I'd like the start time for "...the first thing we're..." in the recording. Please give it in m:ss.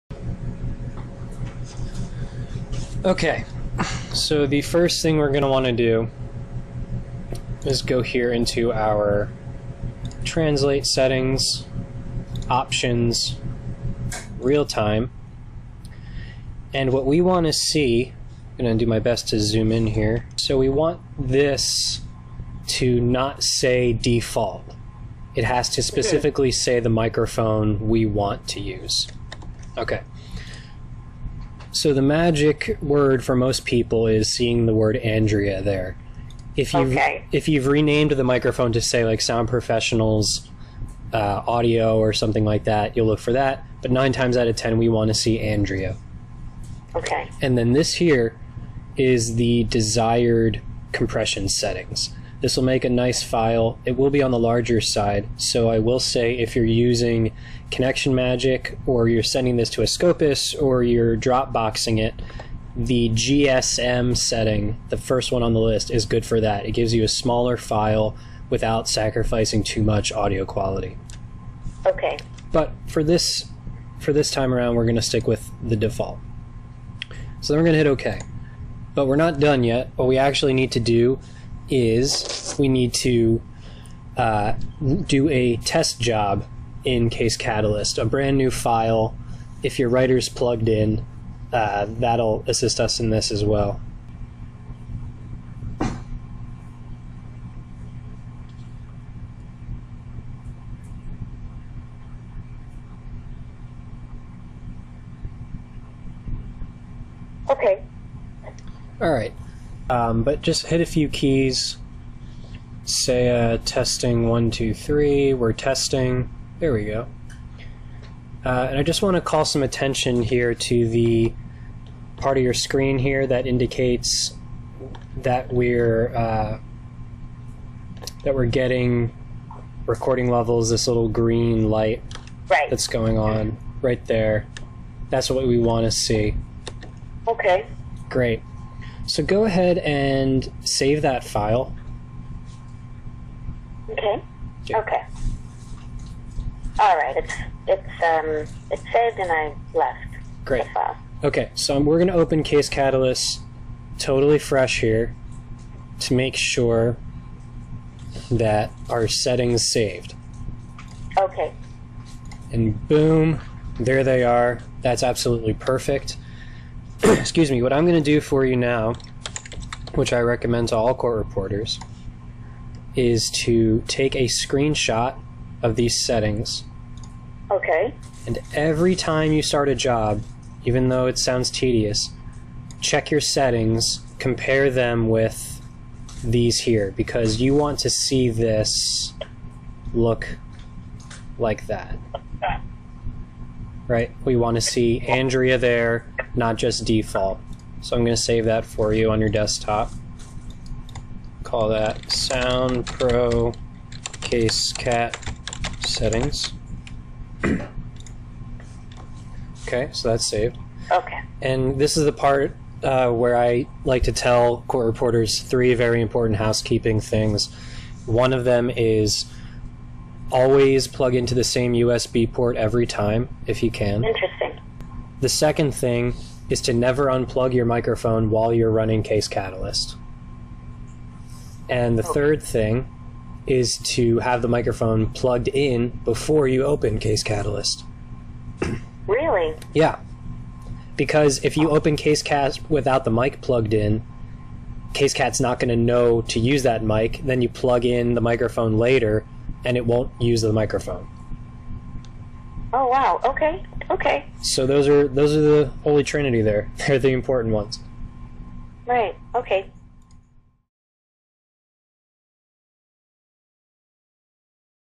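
0:04.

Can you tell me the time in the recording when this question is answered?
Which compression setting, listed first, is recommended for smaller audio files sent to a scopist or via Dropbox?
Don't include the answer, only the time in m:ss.
1:03.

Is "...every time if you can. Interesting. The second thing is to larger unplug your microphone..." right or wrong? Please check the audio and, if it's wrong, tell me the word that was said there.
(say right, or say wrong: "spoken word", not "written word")
wrong: "never", not "larger".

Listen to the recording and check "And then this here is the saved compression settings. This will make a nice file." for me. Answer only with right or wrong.
wrong.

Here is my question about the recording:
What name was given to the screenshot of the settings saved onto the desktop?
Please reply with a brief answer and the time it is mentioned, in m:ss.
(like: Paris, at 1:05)
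Sound Pro Case Cat Settings, at 3:22.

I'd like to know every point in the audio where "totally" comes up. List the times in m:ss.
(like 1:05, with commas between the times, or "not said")
2:33.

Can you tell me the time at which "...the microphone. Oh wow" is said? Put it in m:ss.
4:10.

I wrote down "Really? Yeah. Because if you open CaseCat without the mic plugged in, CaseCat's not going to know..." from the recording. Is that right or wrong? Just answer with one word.
right.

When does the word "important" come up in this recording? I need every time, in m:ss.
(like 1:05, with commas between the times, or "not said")
3:36, 4:17.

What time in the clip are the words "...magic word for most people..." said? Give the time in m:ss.
0:32.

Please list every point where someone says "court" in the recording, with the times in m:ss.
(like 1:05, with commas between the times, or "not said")
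2:50, 3:34.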